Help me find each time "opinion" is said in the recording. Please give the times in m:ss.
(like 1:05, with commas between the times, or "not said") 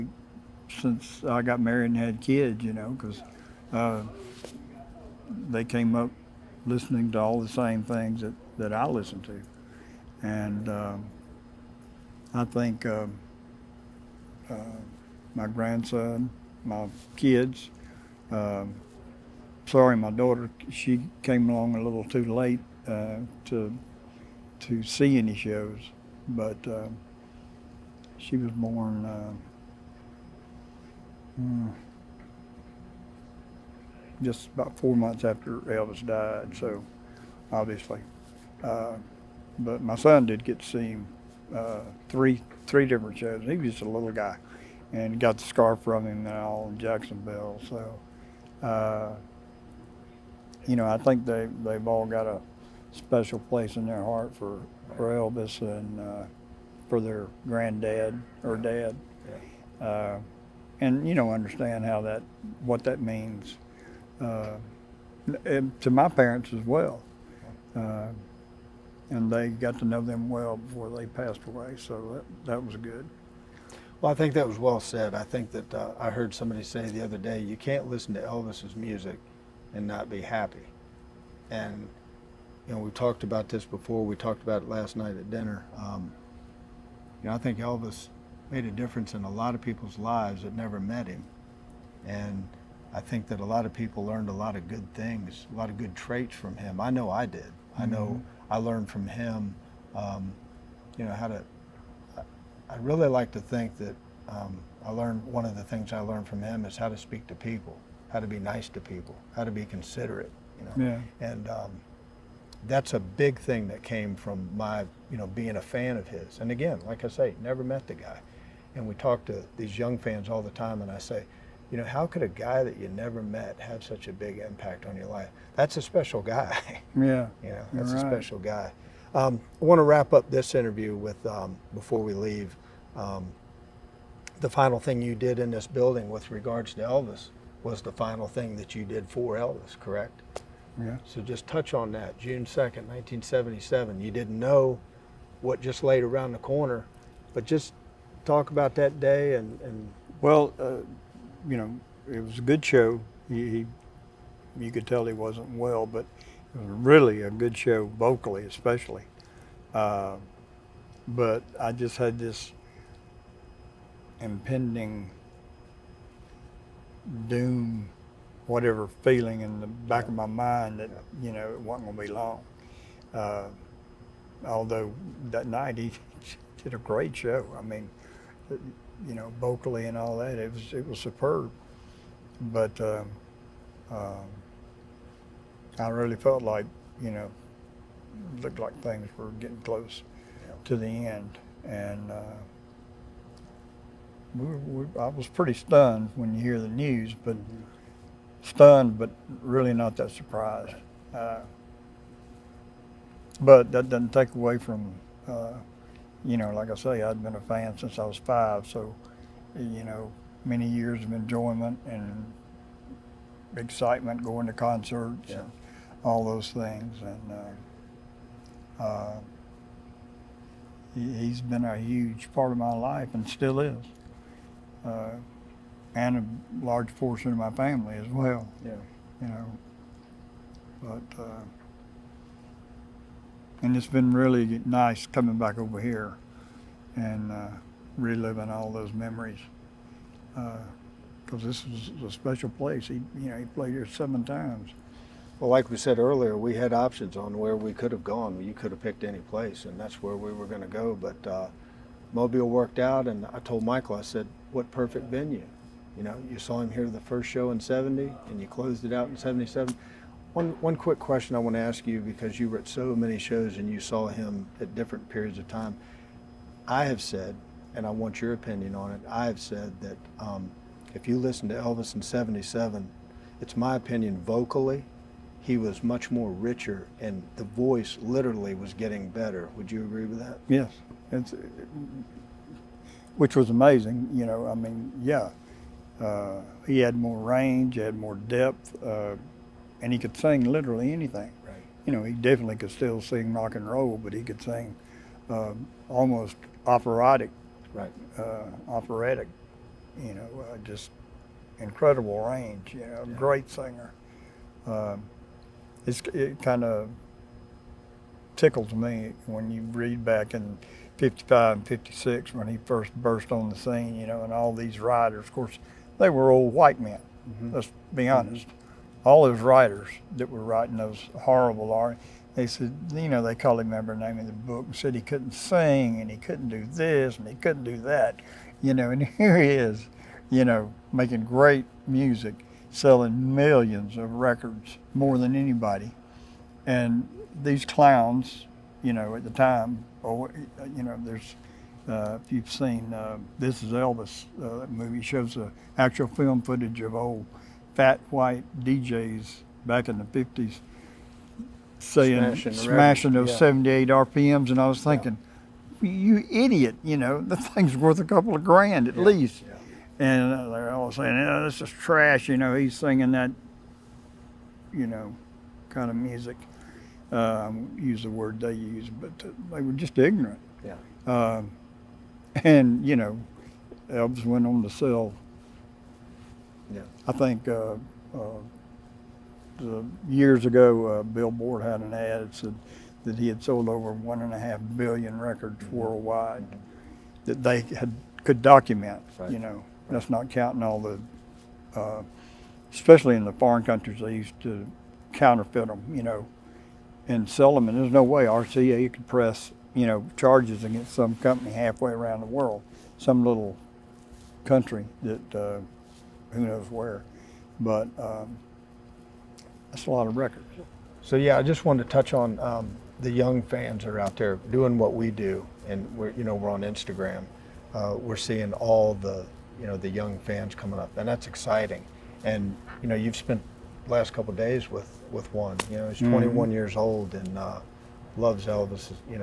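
4:28, 4:33.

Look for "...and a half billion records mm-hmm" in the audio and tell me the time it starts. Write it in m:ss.
6:24.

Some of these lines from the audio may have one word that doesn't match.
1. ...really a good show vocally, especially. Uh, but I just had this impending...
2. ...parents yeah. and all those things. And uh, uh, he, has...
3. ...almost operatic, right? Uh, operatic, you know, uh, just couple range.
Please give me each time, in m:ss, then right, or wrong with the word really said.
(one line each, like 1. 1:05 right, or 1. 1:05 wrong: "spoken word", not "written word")
1. 2:36 right
2. 3:34 wrong: "concerts", not "parents"
3. 4:55 wrong: "incredible", not "couple".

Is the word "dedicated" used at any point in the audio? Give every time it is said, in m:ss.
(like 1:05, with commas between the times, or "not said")
not said.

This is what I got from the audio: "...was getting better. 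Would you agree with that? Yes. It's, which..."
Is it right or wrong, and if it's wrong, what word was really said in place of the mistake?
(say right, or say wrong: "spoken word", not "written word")
right.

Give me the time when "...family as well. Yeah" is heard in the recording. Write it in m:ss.
3:47.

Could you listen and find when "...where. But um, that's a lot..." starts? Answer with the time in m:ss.
6:46.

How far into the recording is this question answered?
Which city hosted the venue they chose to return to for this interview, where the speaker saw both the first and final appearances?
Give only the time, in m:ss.
4:12.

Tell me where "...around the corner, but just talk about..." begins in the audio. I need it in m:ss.
2:26.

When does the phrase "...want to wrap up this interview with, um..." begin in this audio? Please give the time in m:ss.
2:09.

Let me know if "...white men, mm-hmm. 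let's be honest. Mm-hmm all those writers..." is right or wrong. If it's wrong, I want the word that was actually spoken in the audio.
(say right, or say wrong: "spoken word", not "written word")
right.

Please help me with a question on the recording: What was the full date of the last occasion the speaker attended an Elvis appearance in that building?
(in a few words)
June 2, 1977.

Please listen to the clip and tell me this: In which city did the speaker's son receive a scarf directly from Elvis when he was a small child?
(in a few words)
Jacksonville.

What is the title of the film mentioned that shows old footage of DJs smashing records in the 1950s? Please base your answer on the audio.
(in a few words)
This Is Elvis.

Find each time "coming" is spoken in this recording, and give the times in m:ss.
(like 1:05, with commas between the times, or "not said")
3:55, 7:00.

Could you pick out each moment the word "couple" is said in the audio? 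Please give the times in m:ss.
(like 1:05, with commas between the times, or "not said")
5:58, 7:04.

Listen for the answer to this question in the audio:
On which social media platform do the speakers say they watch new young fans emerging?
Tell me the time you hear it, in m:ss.
6:56.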